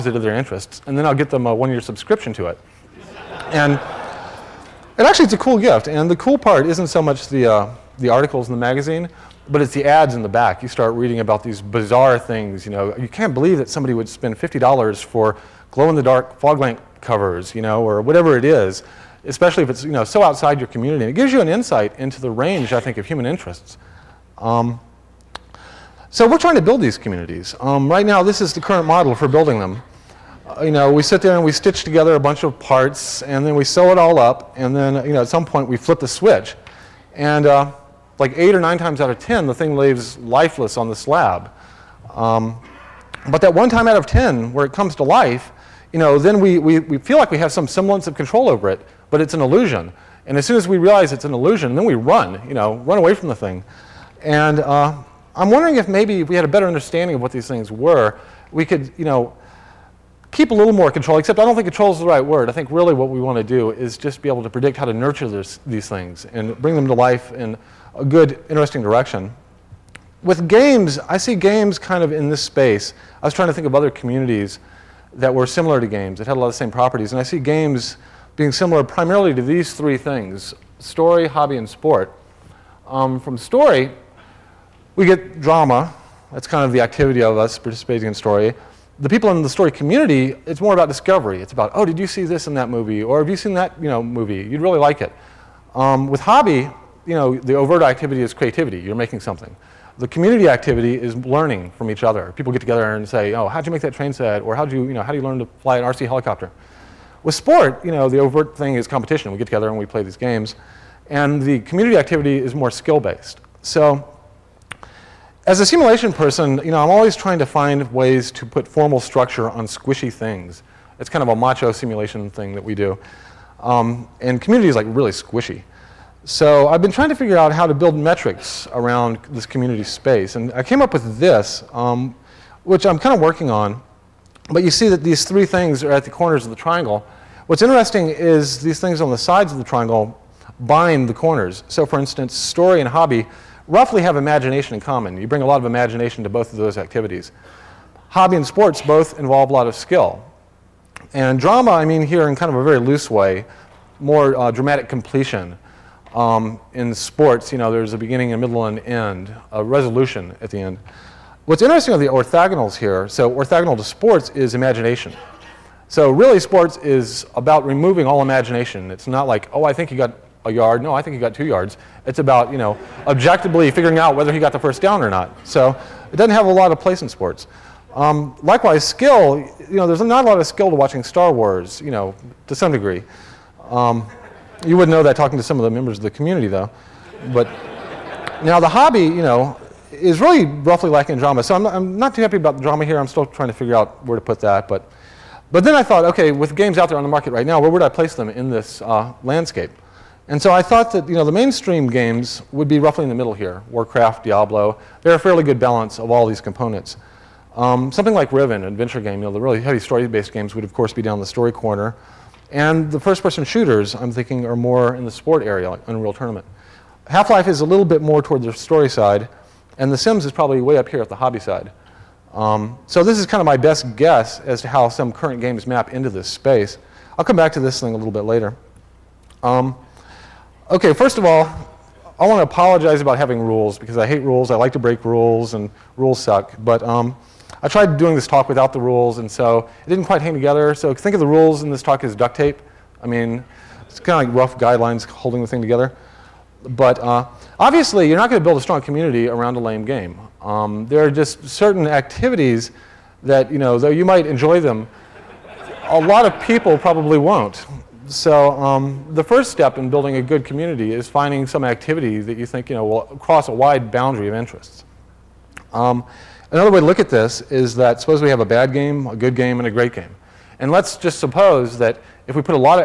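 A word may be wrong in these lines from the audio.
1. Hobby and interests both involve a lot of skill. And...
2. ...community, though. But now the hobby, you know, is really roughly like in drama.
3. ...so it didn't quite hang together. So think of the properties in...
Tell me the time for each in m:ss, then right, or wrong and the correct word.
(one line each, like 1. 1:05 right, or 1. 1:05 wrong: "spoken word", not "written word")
1. 2:28 wrong: "sports", not "interests"
2. 3:06 right
3. 3:59 wrong: "rules", not "properties".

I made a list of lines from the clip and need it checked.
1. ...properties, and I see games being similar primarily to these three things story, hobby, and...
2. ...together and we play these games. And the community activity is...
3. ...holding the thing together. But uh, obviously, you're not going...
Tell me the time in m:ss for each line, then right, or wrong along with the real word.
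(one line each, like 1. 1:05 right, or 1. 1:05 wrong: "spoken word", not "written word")
1. 1:16 right
2. 1:49 right
3. 4:05 right.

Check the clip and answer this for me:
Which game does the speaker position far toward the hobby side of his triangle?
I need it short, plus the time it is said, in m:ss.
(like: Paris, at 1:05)
The Sims, at 3:39.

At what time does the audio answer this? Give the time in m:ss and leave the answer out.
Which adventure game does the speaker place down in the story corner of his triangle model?
3:28.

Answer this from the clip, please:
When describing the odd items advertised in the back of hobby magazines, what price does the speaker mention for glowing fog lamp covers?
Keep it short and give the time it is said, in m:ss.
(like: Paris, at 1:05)
$50, at 0:14.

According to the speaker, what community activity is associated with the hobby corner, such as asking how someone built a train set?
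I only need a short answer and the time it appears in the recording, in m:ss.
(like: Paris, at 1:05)
Learning from each other, at 1:41.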